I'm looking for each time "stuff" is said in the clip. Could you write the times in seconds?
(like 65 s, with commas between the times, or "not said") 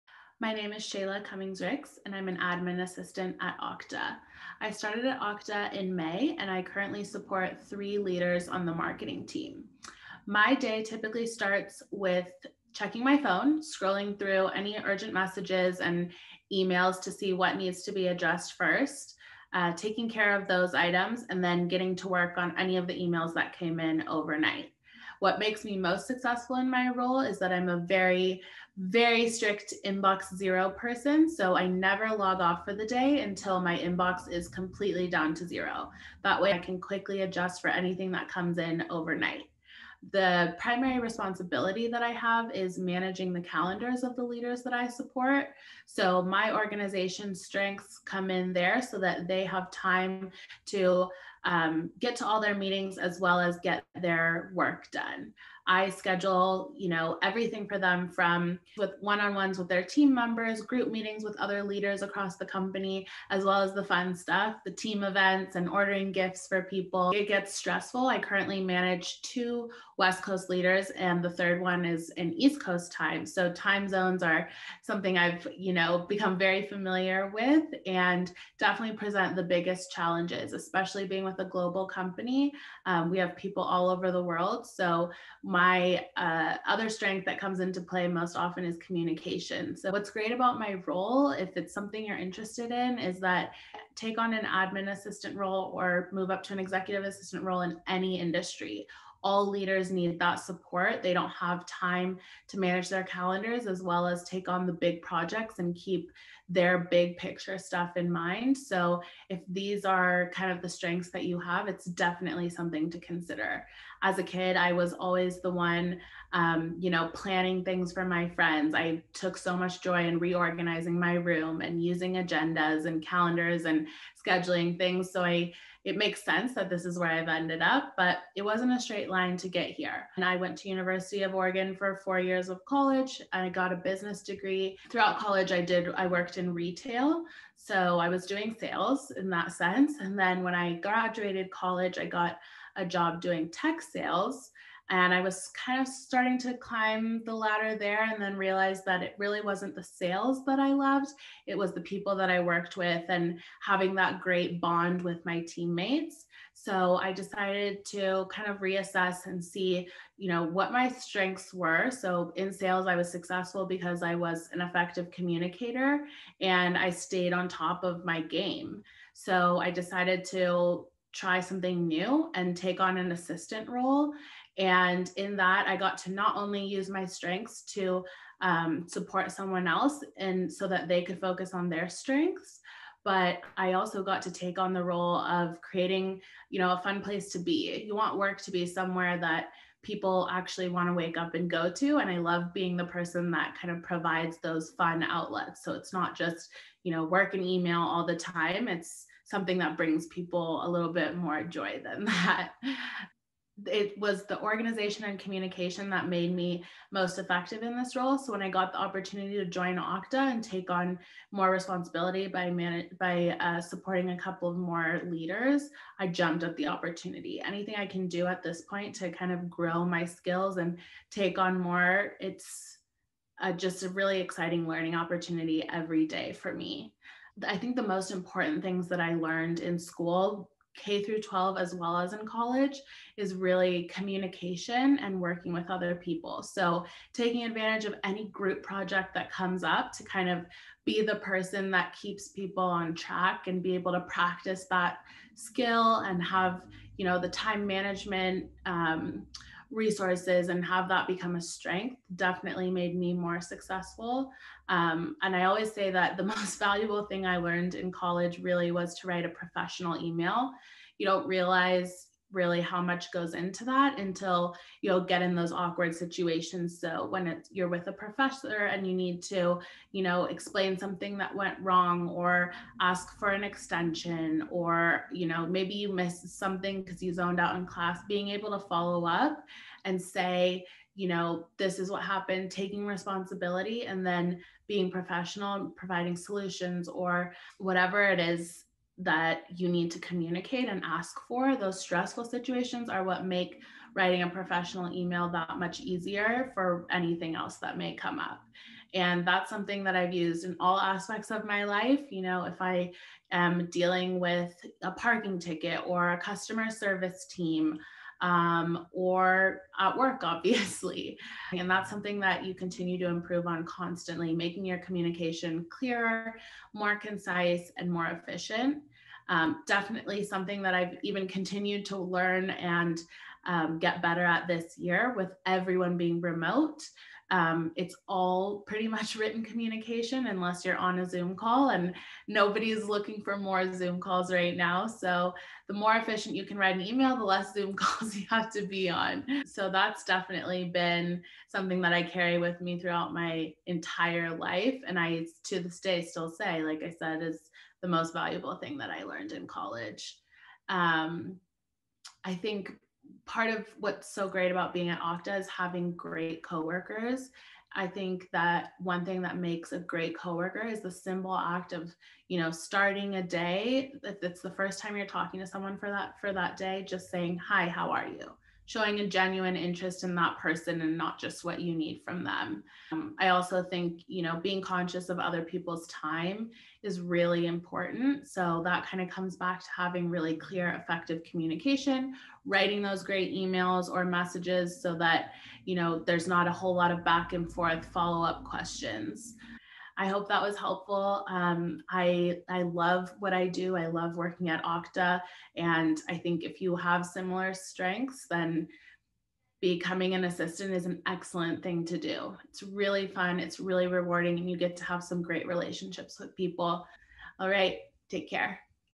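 64 s, 107 s.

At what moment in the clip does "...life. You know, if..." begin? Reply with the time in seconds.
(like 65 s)
301 s.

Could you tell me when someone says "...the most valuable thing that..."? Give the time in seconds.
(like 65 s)
347 s.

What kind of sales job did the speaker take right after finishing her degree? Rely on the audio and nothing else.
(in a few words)
Tech sales.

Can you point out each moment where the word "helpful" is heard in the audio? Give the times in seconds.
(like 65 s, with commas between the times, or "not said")
390 s.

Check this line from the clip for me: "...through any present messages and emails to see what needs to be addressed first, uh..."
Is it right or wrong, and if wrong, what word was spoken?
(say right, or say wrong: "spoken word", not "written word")
wrong: "urgent", not "present".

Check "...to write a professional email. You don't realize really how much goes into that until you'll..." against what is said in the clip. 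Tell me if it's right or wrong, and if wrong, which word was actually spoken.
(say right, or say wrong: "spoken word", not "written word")
right.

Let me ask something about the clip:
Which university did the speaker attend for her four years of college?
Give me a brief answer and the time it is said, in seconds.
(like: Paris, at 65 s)
University of Oregon, at 130 s.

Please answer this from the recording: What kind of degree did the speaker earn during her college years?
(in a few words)
Business degree.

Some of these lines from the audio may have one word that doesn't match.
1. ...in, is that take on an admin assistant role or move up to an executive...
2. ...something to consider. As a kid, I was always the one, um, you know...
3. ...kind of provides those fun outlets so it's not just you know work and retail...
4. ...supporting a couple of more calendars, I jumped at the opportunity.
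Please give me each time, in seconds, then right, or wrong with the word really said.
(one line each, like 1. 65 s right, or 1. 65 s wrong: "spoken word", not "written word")
1. 92 s right
2. 112 s right
3. 193 s wrong: "email", not "retail"
4. 213 s wrong: "leaders", not "calendars".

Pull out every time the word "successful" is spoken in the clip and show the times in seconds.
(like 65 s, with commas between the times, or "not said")
26 s, 163 s, 253 s.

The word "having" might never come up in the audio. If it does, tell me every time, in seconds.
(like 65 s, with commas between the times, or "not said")
153 s, 355 s, 379 s.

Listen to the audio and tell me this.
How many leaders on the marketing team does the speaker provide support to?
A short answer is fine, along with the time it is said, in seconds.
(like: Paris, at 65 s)
3, at 7 s.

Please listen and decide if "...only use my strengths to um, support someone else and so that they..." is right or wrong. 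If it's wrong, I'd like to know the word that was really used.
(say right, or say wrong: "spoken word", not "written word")
right.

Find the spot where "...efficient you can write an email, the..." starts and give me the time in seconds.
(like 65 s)
335 s.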